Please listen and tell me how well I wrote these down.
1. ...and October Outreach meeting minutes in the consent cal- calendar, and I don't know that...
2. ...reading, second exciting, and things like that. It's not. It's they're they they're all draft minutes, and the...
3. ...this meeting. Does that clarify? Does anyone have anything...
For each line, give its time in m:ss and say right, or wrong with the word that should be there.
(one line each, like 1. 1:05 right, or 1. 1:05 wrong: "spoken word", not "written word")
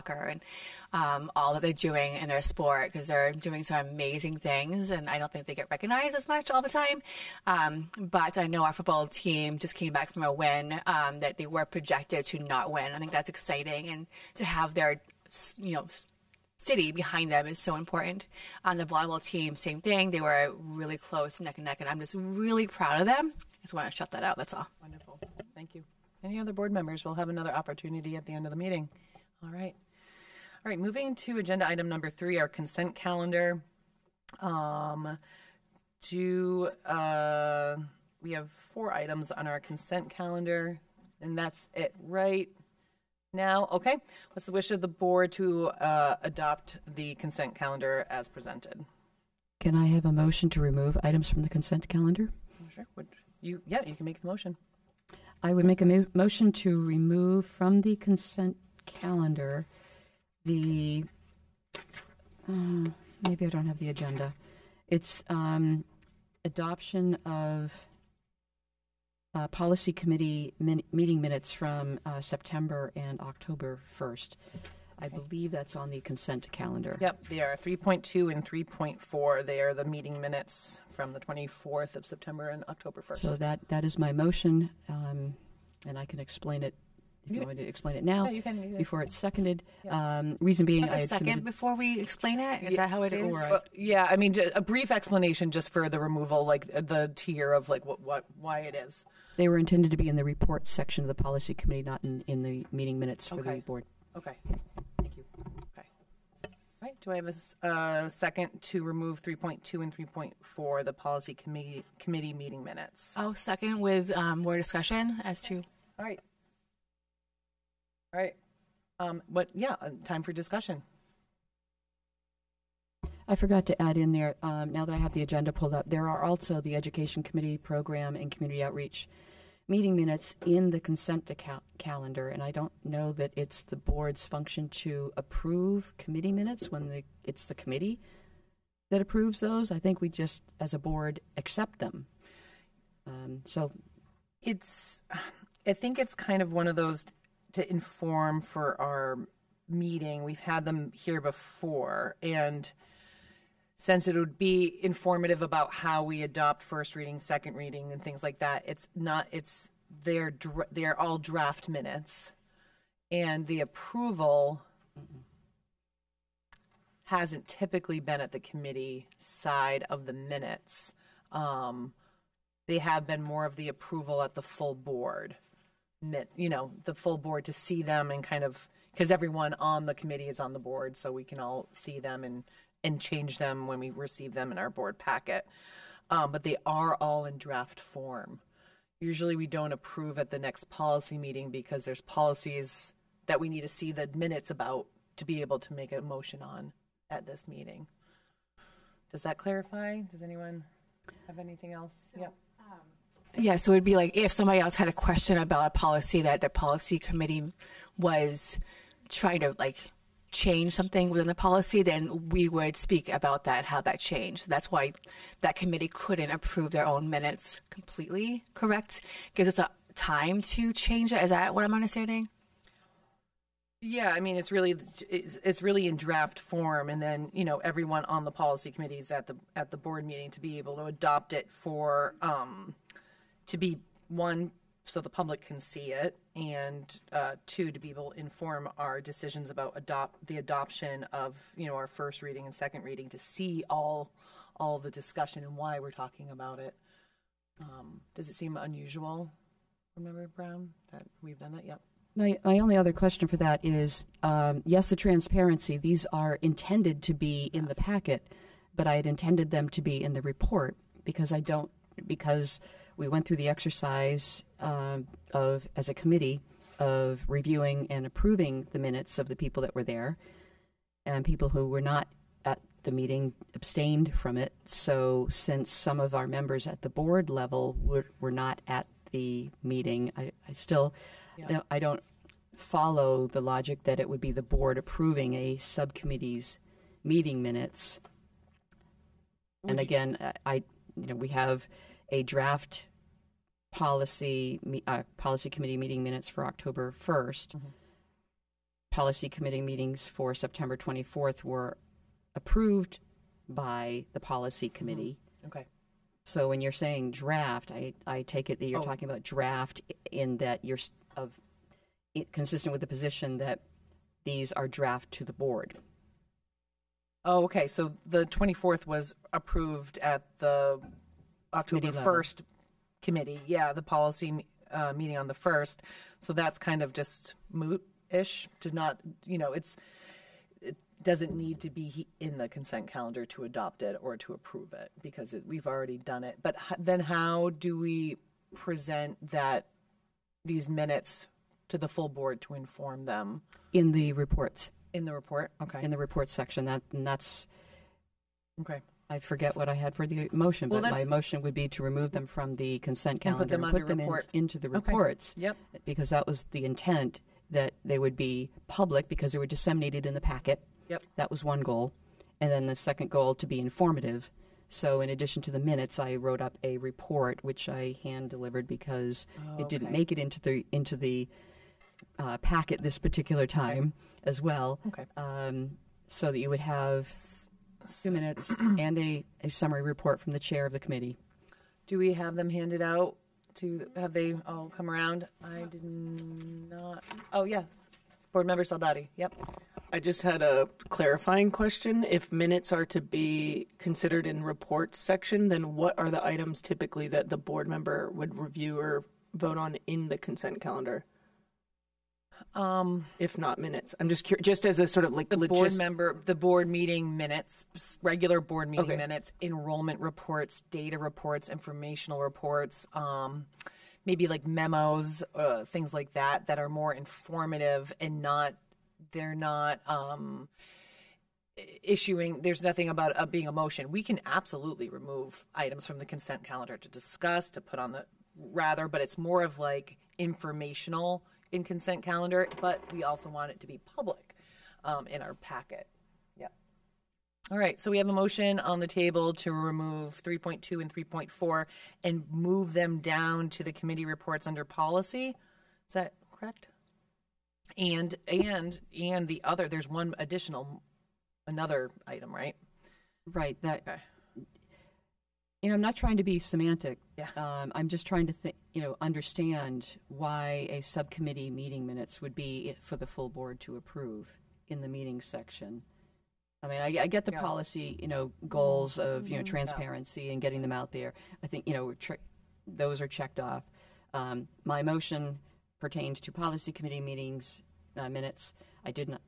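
1. 2:08 wrong: "Community", not "October"
2. 2:36 wrong: "reading", not "exciting"
3. 3:17 right.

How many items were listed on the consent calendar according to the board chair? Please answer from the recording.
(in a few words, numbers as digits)
4.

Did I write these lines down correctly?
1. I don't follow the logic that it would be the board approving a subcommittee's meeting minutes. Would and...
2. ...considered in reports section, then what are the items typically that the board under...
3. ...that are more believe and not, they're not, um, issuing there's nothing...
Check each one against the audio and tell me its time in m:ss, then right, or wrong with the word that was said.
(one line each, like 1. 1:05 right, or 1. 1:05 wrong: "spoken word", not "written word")
1. 4:41 right
2. 6:33 wrong: "member", not "under"
3. 6:56 wrong: "informative", not "believe".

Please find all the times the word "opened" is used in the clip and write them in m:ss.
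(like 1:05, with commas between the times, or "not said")
not said.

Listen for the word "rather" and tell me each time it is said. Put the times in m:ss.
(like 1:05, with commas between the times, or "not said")
7:08.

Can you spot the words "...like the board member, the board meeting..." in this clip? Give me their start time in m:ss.
6:45.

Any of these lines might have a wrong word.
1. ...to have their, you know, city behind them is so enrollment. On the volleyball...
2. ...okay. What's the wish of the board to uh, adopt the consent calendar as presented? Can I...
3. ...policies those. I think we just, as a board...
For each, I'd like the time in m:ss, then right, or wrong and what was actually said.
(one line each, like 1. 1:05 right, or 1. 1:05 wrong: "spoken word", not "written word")
1. 0:14 wrong: "important", not "enrollment"
2. 0:43 right
3. 2:19 wrong: "approves", not "policies".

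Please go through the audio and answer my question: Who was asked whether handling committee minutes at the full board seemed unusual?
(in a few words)
Member Brown.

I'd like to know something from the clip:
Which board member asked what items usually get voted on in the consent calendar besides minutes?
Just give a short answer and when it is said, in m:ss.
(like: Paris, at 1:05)
Soldati, at 6:28.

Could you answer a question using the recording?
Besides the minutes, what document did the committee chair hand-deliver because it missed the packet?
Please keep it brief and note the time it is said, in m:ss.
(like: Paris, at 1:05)
a report, at 6:06.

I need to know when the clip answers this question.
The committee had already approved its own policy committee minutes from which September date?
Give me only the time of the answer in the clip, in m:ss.
5:00.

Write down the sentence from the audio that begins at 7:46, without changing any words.
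I mean, I, I get the yeah.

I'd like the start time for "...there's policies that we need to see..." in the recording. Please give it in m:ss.
3:11.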